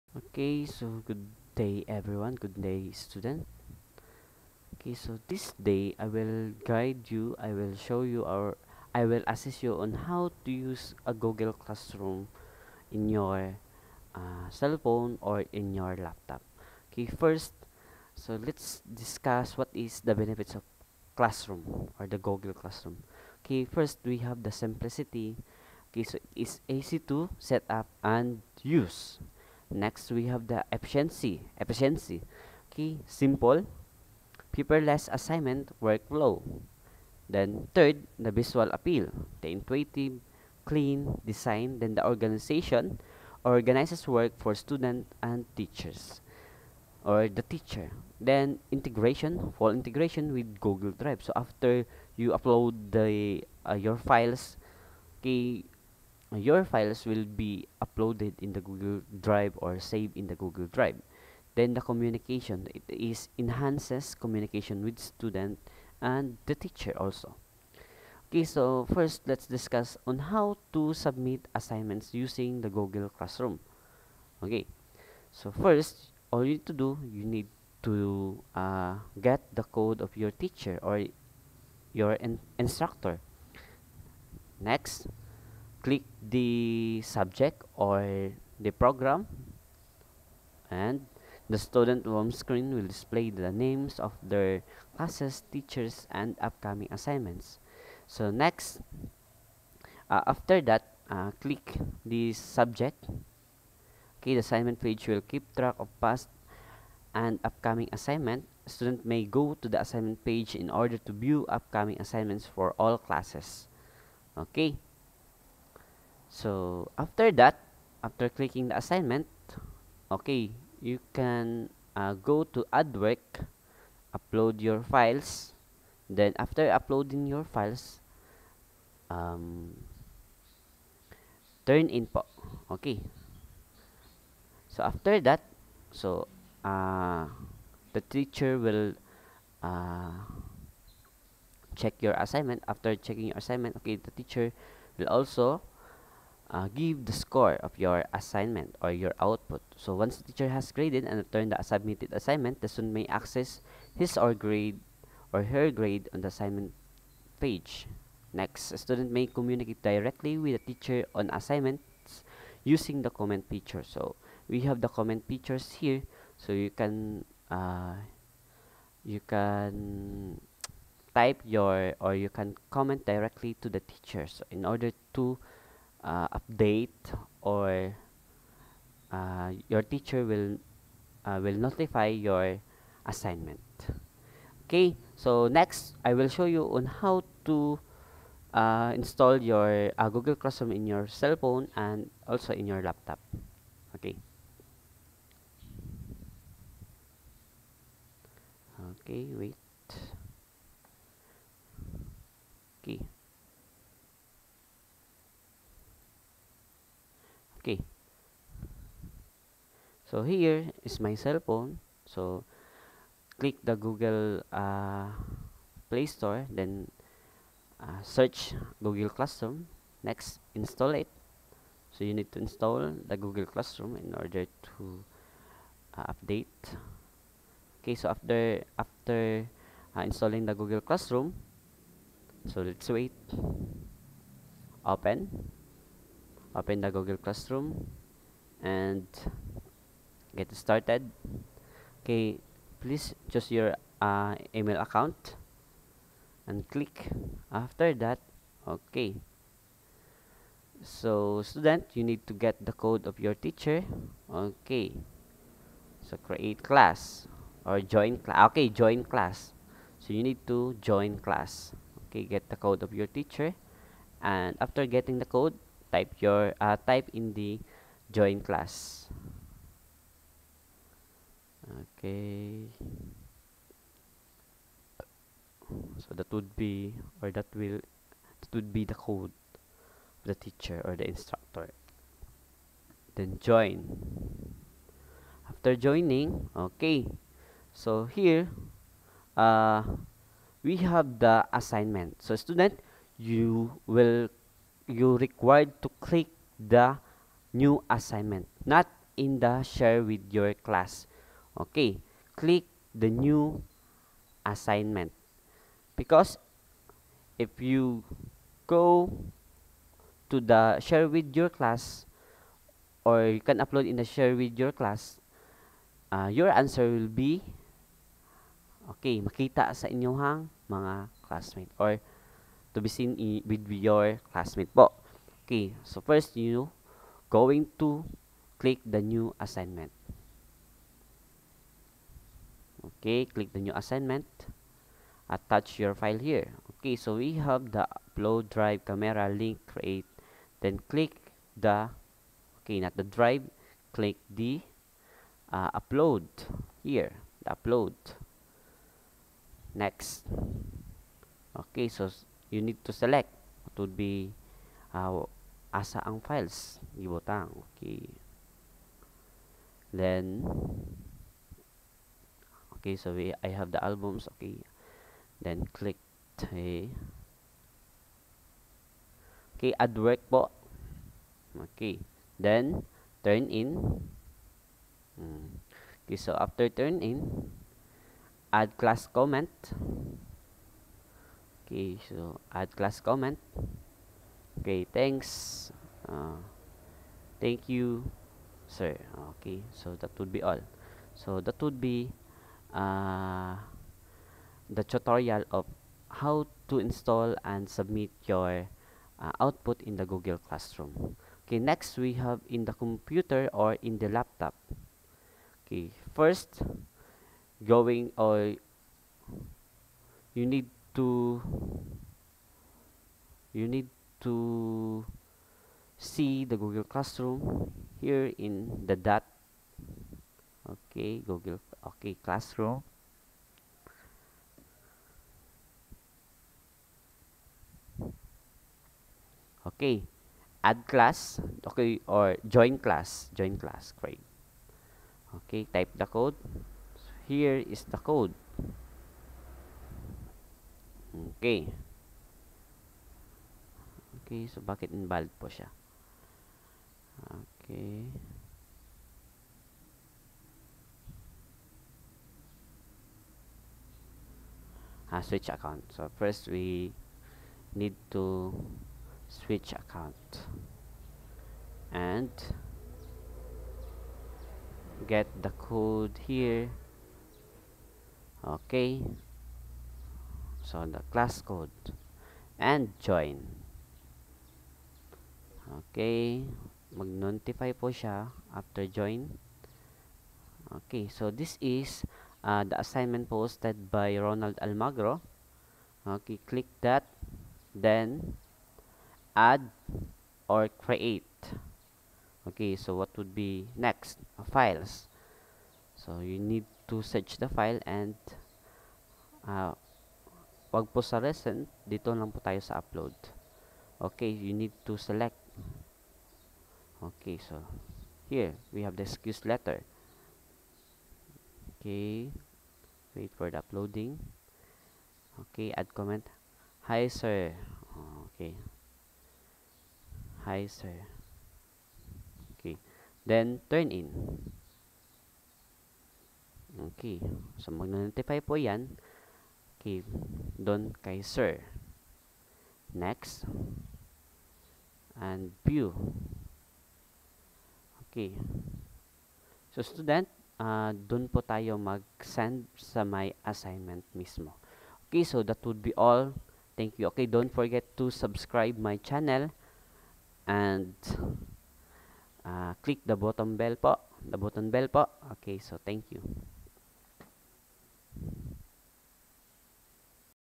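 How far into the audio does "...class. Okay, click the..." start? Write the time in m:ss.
5:00.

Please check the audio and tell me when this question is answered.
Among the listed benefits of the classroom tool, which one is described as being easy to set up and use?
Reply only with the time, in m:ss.
0:24.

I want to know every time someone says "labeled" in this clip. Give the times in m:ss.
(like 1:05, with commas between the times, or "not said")
not said.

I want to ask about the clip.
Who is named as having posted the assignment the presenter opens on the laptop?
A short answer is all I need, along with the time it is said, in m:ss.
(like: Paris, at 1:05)
Ronald Almagro, at 8:04.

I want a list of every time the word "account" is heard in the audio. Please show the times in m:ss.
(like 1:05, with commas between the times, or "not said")
4:04, 7:35, 7:39.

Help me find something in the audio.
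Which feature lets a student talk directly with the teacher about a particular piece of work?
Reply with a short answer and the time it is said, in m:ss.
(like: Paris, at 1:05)
Comment feature, at 2:43.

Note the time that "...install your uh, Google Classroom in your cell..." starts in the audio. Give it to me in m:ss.
3:08.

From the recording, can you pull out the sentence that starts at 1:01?
Then the communication, it is enhances communication with student and the teacher also.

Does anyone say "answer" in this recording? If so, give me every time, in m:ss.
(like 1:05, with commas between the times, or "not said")
5:16.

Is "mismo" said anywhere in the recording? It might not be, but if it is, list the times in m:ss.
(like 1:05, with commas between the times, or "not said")
9:04.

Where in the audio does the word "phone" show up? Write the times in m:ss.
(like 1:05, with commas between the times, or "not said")
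0:14, 3:11, 3:31.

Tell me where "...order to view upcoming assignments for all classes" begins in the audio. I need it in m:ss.
1:50.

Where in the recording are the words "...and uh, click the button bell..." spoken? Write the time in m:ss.
9:10.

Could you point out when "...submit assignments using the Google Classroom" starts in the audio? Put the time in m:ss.
1:10.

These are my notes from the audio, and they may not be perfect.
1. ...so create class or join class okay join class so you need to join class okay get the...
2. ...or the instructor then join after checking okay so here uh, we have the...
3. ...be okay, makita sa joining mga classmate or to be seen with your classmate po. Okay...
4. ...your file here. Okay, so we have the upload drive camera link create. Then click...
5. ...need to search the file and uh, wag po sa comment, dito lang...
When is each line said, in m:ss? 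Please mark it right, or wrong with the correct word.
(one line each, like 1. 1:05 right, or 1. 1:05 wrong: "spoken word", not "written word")
1. 4:16 right
2. 4:40 wrong: "joining", not "checking"
3. 5:17 wrong: "inyong", not "joining"
4. 5:35 right
5. 8:16 wrong: "recent", not "comment".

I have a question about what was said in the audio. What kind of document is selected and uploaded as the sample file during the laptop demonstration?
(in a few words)
Excuse letter.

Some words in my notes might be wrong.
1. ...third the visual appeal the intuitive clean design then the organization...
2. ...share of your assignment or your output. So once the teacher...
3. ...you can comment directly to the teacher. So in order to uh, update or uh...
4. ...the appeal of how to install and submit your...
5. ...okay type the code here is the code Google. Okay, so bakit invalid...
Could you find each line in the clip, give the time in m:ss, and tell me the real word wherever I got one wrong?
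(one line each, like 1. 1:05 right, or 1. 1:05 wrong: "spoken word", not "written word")
1. 0:37 right
2. 2:27 wrong: "score", not "share"
3. 2:52 right
4. 6:34 wrong: "tutorial", not "appeal"
5. 7:15 wrong: "Okay", not "Google".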